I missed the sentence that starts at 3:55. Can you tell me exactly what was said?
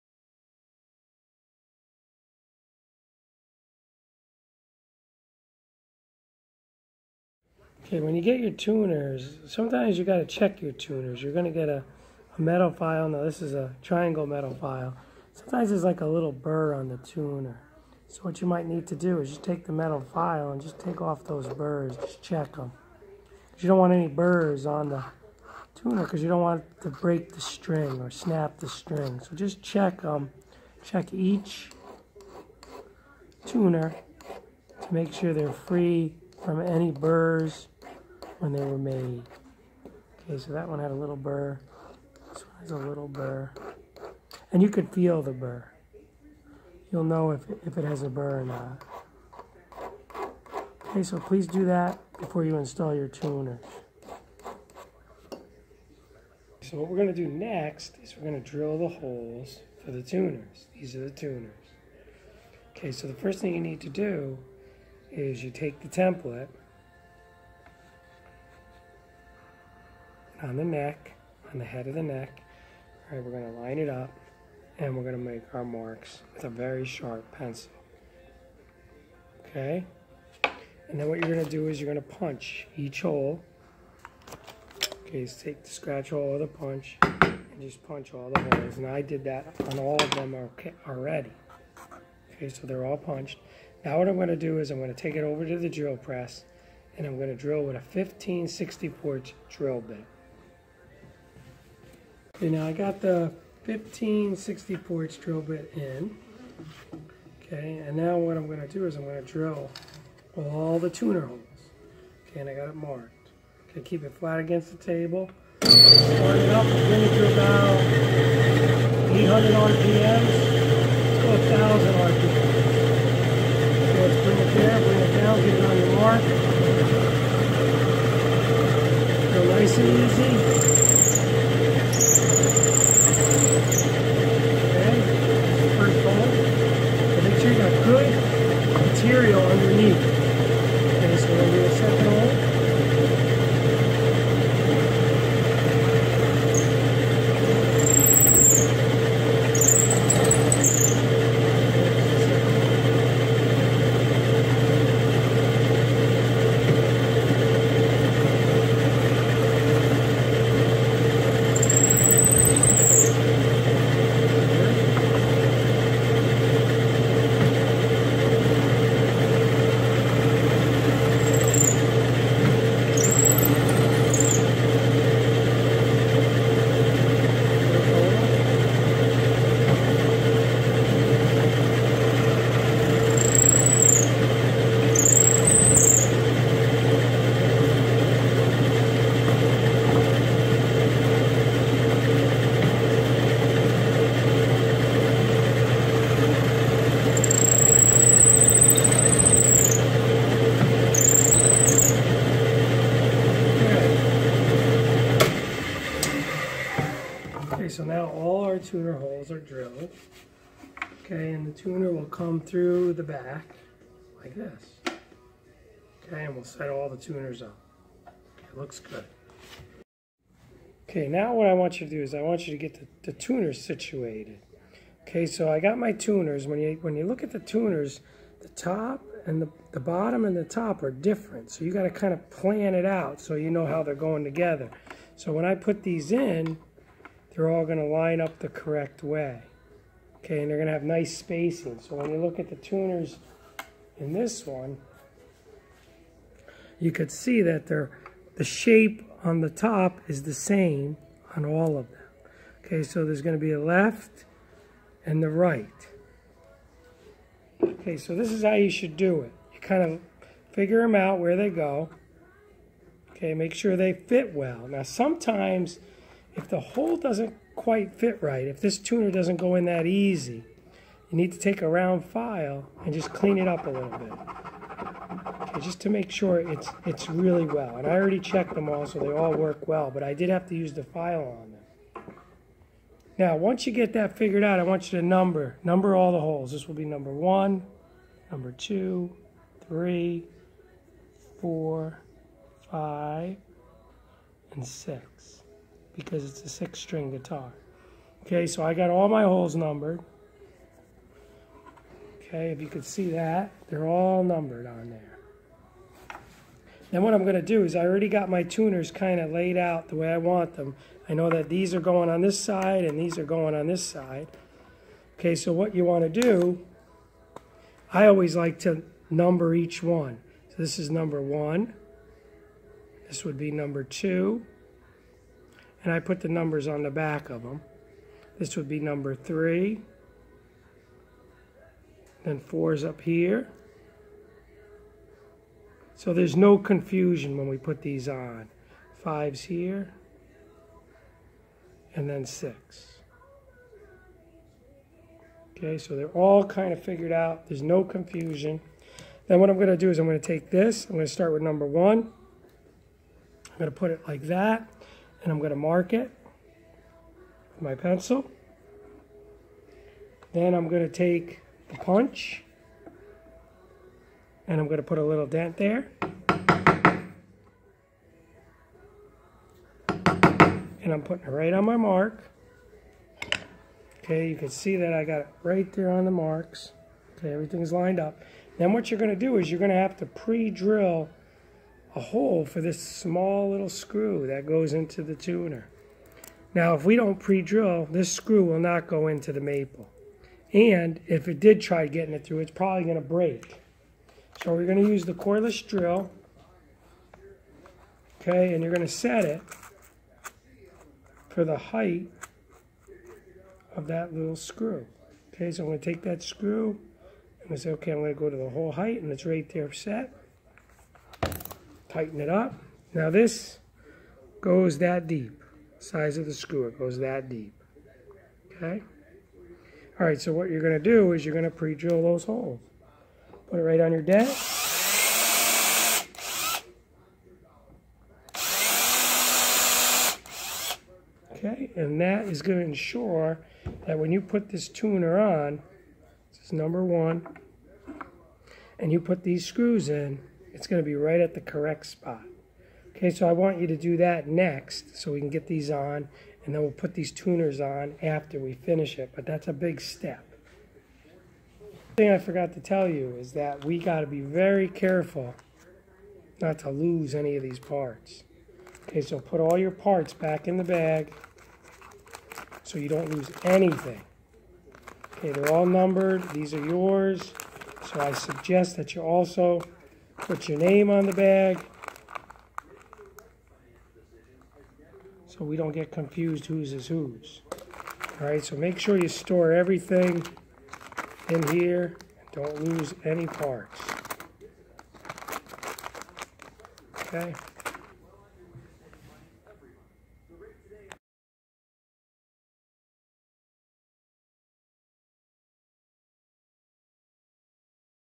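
So when I put these in, they're all going to line up the correct way.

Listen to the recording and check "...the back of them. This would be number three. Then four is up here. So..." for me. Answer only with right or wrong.
right.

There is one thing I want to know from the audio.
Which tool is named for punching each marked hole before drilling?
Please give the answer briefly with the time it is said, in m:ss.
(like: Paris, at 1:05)
Scratch awl, at 1:25.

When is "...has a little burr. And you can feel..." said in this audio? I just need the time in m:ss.
0:42.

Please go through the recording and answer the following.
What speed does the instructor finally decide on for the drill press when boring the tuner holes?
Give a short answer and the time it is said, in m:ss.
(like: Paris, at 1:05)
1,000 RPMs, at 2:01.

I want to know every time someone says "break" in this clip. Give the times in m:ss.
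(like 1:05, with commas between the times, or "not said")
0:26, 6:33.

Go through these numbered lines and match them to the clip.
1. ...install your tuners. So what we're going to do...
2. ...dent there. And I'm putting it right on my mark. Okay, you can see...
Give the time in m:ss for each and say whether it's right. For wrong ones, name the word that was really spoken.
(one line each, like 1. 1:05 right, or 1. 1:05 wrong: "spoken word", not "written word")
1. 0:52 right
2. 6:05 right.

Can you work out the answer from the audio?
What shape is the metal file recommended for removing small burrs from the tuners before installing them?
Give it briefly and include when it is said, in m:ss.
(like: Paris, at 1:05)
Triangle, at 0:13.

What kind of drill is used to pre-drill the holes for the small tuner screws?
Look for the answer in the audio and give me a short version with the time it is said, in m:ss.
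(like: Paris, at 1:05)
Cordless drill, at 6:35.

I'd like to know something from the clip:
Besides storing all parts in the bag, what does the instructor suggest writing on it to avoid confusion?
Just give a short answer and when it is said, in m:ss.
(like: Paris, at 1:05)
Your name, at 7:50.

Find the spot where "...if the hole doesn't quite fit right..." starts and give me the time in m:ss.
4:26.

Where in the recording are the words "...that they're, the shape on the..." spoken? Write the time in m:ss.
4:07.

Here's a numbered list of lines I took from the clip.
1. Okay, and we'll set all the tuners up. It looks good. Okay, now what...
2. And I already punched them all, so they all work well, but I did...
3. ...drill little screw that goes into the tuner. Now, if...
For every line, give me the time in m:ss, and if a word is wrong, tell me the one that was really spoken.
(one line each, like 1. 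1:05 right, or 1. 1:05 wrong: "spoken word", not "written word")
1. 3:36 right
2. 4:37 wrong: "checked", not "punched"
3. 6:22 wrong: "small", not "drill".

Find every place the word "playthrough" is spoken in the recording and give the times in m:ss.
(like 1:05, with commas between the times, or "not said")
not said.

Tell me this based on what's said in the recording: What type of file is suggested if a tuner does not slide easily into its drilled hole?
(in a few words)
Round file.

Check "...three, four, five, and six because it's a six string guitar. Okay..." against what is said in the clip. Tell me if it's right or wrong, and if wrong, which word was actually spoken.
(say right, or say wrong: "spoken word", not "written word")
right.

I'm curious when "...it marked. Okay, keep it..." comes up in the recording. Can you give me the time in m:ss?
1:52.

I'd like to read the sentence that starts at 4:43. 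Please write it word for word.
Now, once you get that figured out, I want you to number.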